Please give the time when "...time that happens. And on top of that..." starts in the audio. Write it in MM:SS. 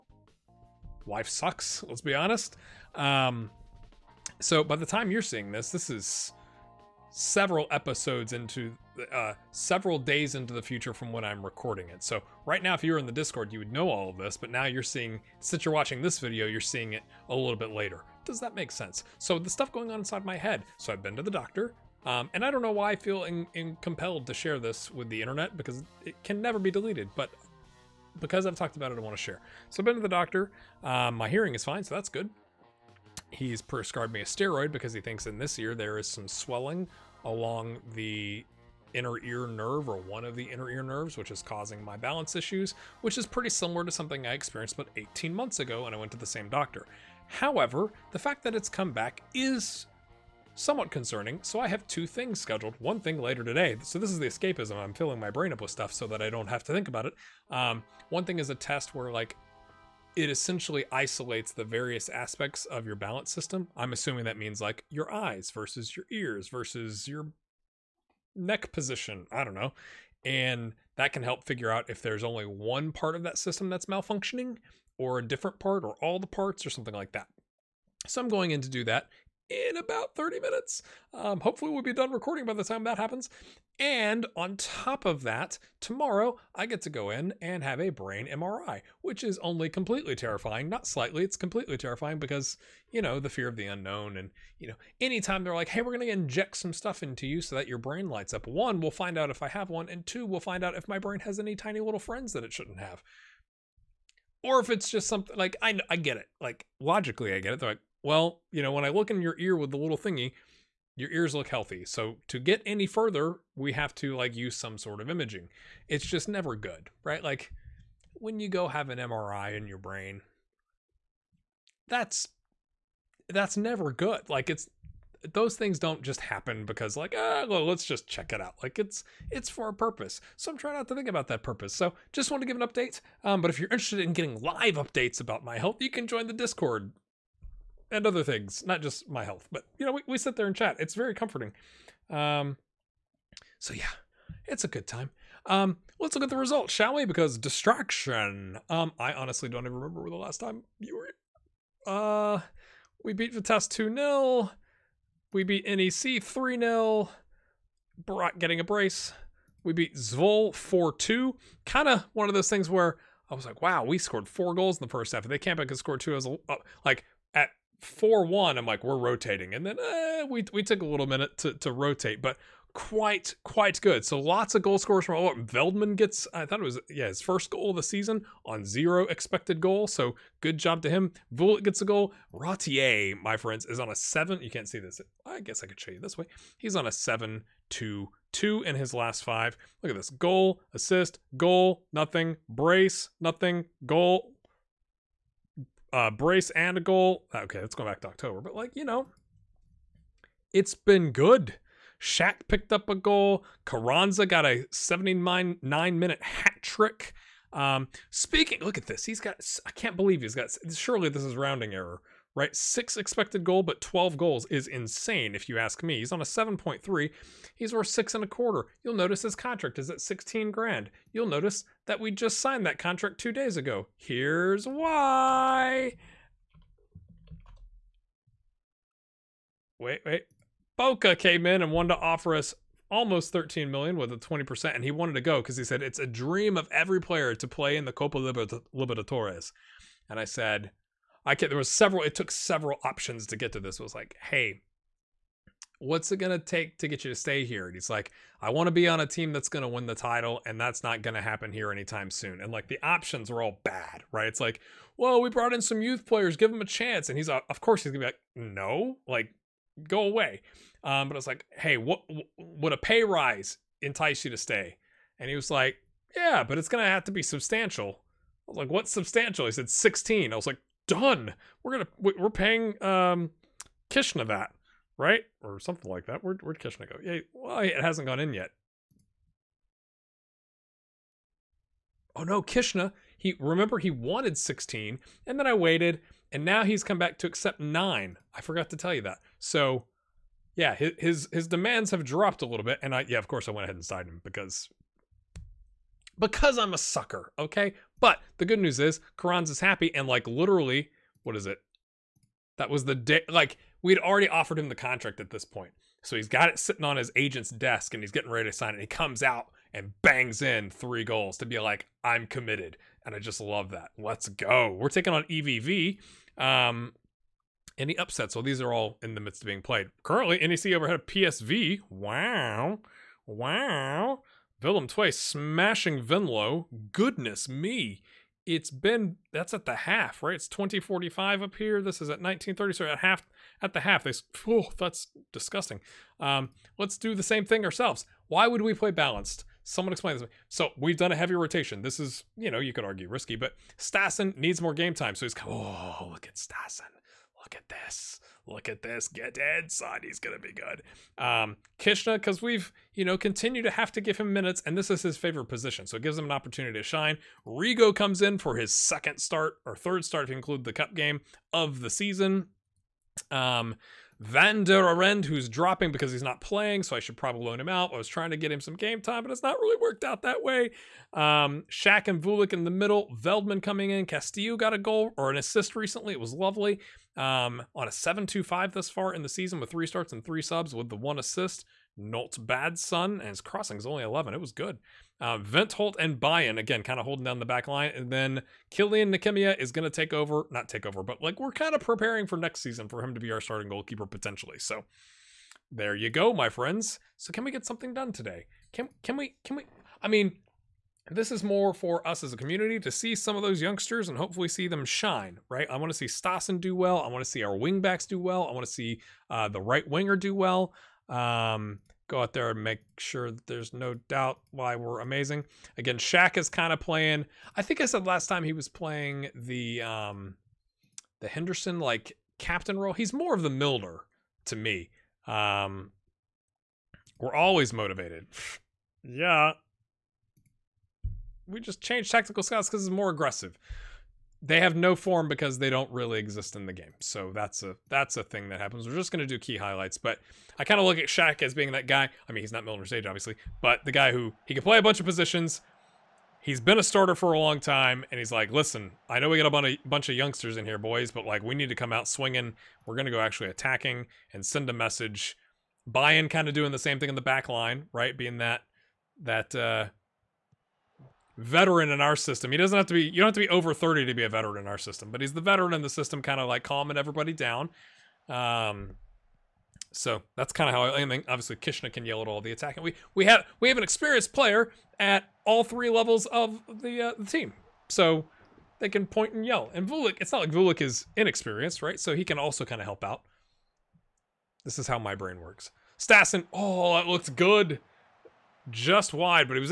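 01:22.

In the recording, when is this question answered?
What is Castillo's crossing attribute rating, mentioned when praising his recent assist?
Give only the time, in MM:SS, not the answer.
06:24.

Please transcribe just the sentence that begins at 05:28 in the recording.
It's been that's at the half, right?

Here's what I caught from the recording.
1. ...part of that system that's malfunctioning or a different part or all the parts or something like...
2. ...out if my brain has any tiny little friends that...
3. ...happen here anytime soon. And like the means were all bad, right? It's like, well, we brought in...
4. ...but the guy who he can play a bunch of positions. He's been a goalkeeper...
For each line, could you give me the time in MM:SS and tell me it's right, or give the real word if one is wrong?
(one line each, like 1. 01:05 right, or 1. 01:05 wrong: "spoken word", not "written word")
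1. 01:12 right
2. 01:40 right
3. 04:11 wrong: "options", not "means"
4. 07:23 wrong: "starter", not "goalkeeper".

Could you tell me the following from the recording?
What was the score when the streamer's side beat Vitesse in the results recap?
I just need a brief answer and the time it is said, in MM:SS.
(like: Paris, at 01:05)
2-0, at 02:33.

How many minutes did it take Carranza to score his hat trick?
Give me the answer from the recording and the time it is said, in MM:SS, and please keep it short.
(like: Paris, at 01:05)
79, at 03:24.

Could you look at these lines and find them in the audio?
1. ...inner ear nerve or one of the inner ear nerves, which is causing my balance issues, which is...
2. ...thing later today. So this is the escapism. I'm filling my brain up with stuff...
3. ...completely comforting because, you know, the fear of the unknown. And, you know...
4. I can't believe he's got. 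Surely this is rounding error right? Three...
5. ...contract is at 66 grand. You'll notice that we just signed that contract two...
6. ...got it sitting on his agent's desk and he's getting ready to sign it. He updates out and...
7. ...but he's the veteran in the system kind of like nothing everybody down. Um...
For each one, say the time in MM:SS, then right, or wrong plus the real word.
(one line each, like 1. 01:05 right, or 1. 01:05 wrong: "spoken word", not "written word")
1. 00:38 right
2. 00:52 right
3. 01:31 wrong: "terrifying", not "comforting"
4. 03:29 wrong: "Six", not "Three"
5. 03:39 wrong: "16", not "66"
6. 05:06 wrong: "comes", not "updates"
7. 07:45 wrong: "calming", not "nothing".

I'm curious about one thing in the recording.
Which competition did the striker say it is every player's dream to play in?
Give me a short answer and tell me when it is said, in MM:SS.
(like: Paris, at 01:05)
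Copa Libertadores, at 03:57.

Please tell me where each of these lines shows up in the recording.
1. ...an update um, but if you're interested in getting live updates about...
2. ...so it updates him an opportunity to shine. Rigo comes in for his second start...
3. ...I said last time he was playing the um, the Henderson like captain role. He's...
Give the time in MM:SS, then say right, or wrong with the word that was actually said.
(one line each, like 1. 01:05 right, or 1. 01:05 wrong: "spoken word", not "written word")
1. 02:12 right
2. 05:55 wrong: "gives", not "updates"
3. 06:57 right.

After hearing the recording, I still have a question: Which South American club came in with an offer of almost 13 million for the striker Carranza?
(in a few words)
Boca.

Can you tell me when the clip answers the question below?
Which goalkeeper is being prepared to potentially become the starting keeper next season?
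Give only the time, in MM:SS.
06:28.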